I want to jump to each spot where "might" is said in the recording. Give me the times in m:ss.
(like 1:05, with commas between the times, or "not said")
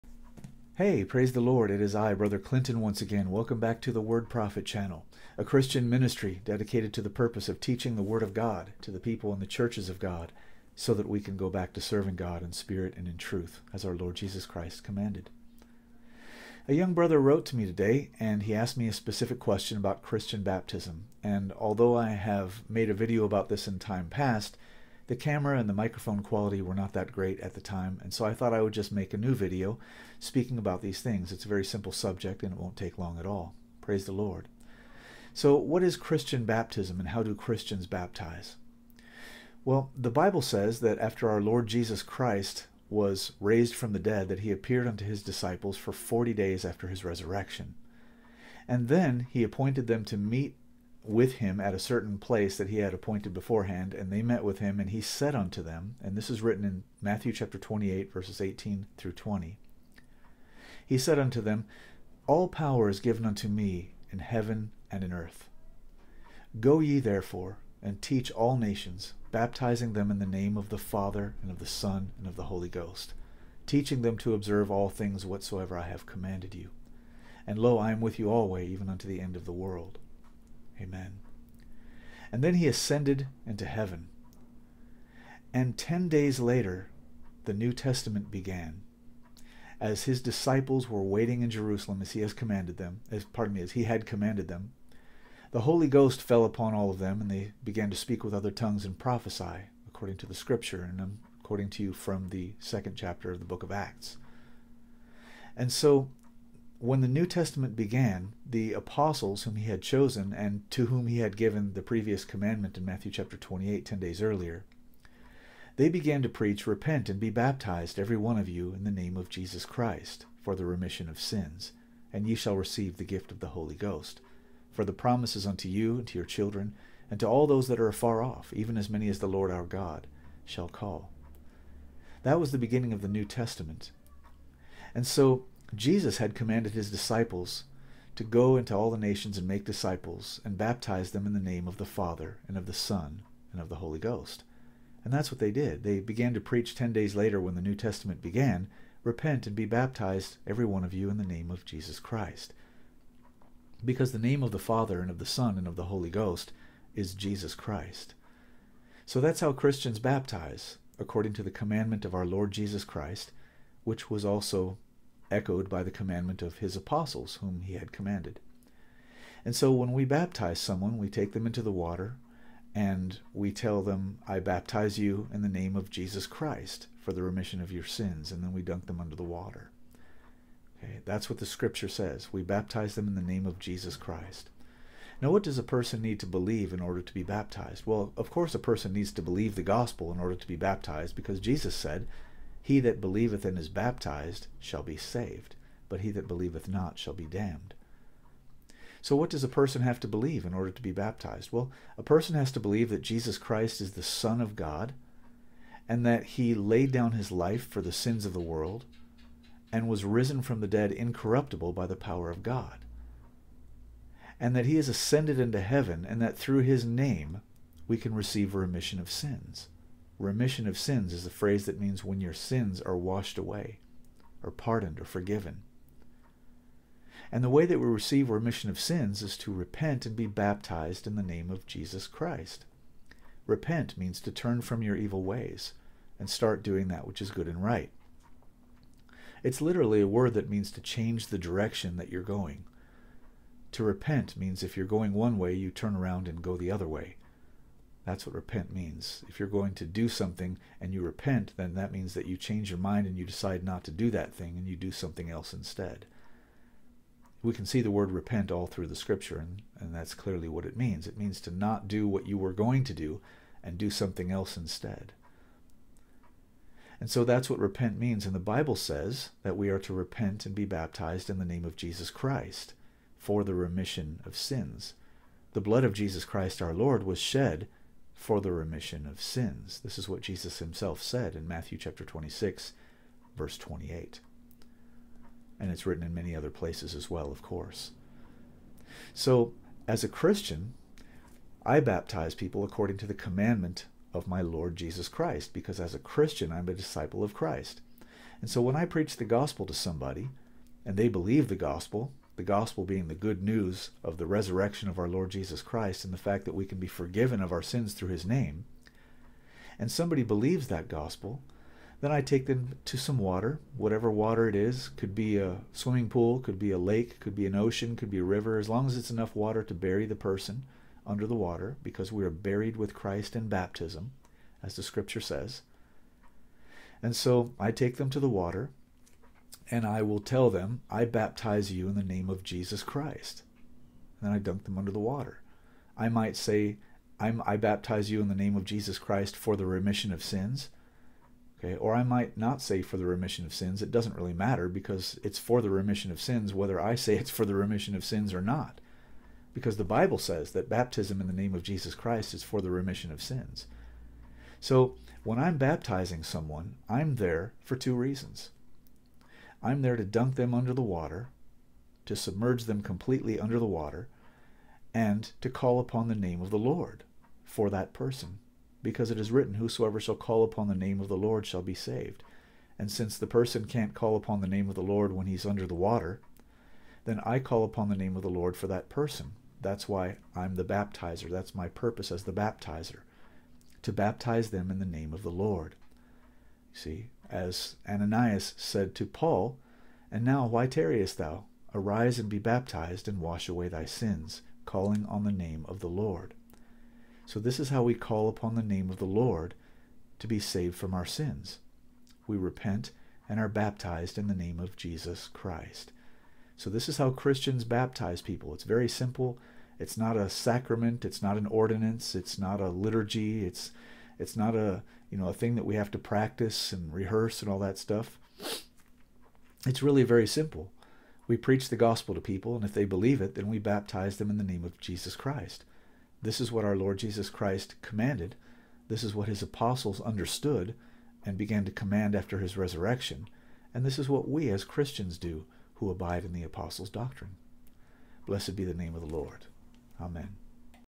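5:36, 5:42.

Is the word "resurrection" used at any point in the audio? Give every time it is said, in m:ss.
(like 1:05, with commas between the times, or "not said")
0:47, 5:04, 7:12.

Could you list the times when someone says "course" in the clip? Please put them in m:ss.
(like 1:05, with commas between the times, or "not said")
3:08, 4:47.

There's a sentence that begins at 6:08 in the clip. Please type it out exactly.
Because it is written, Whosoever shall call upon the name of the Lord shall be saved.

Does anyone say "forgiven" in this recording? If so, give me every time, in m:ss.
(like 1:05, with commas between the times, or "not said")
3:45, 5:06.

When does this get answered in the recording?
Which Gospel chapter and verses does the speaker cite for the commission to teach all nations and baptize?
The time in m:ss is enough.
0:57.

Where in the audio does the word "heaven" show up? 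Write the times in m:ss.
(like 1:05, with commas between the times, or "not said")
1:04, 1:23, 3:35.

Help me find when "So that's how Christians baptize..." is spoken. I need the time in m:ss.
2:39.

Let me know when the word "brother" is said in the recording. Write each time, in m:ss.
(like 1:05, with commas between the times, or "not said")
0:02, 0:16.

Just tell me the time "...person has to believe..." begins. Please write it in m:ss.
3:22.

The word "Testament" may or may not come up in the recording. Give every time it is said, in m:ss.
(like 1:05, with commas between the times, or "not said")
1:27, 1:47, 2:13, 2:27.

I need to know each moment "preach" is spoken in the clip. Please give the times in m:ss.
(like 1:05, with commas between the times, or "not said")
1:56, 2:26, 4:58, 7:01.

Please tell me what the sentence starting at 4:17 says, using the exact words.
We can see the word repent all through the scripture, and, and that's clearly what it means.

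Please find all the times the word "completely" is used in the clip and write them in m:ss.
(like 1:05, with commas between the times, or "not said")
6:02.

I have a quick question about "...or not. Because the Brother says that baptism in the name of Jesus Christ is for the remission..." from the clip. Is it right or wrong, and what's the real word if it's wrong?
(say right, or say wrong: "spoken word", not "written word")
wrong: "Bible", not "Brother".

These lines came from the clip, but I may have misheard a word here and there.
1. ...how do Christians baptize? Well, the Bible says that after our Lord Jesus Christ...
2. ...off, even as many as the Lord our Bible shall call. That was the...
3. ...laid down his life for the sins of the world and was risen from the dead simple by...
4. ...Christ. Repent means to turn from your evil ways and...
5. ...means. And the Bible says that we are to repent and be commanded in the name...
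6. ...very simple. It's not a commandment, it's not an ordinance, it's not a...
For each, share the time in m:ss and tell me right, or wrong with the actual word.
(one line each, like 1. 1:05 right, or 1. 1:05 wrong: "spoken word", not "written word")
1. 0:37 right
2. 2:08 wrong: "God", not "Bible"
3. 3:26 wrong: "incorruptible", not "simple"
4. 3:52 right
5. 4:27 wrong: "baptized", not "commanded"
6. 6:48 wrong: "sacrament", not "commandment".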